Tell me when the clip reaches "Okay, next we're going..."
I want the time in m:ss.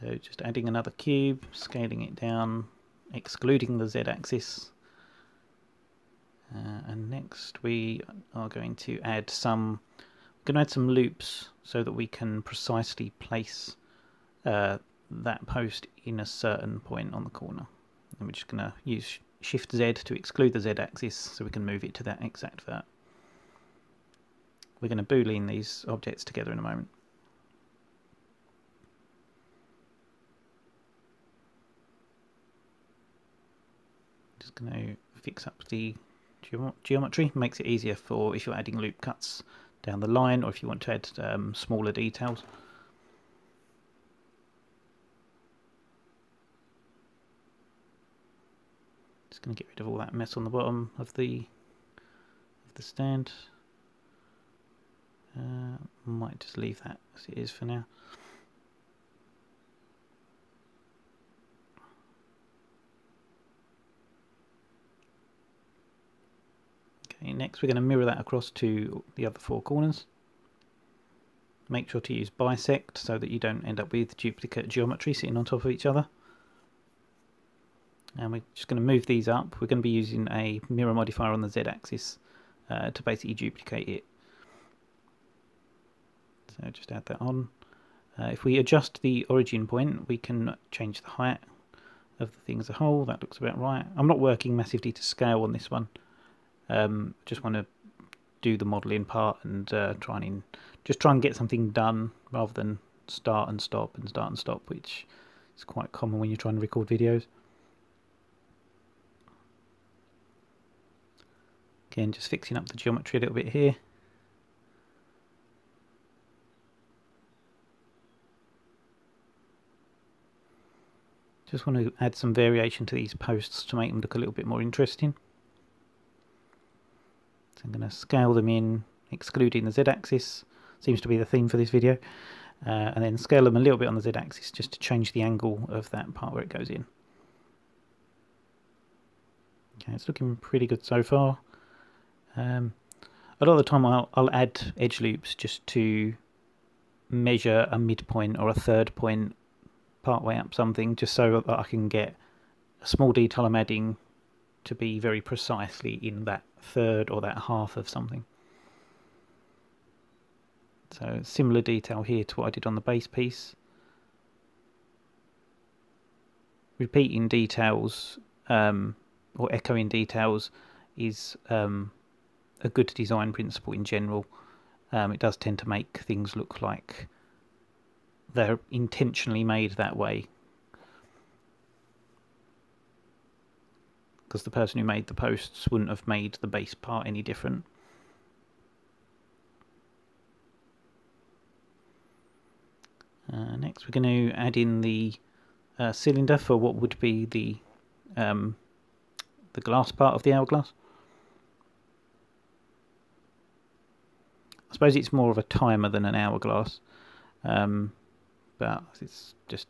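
1:07.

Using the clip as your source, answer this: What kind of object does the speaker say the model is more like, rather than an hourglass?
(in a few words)
a timer.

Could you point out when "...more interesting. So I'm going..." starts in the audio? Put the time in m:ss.
2:04.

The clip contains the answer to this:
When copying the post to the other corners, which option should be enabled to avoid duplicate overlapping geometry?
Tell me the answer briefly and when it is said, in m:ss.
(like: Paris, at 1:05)
bisect, at 1:12.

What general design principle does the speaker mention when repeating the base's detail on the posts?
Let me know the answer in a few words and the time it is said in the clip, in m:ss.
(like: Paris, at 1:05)
echoing details, at 2:49.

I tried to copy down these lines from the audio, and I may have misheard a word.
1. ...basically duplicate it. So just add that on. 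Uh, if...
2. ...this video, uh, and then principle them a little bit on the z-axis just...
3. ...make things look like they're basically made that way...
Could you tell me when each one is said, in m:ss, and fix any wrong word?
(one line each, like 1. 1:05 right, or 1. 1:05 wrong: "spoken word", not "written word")
1. 1:23 right
2. 2:11 wrong: "scale", not "principle"
3. 2:55 wrong: "intentionally", not "basically".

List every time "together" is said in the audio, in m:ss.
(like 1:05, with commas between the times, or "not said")
0:26.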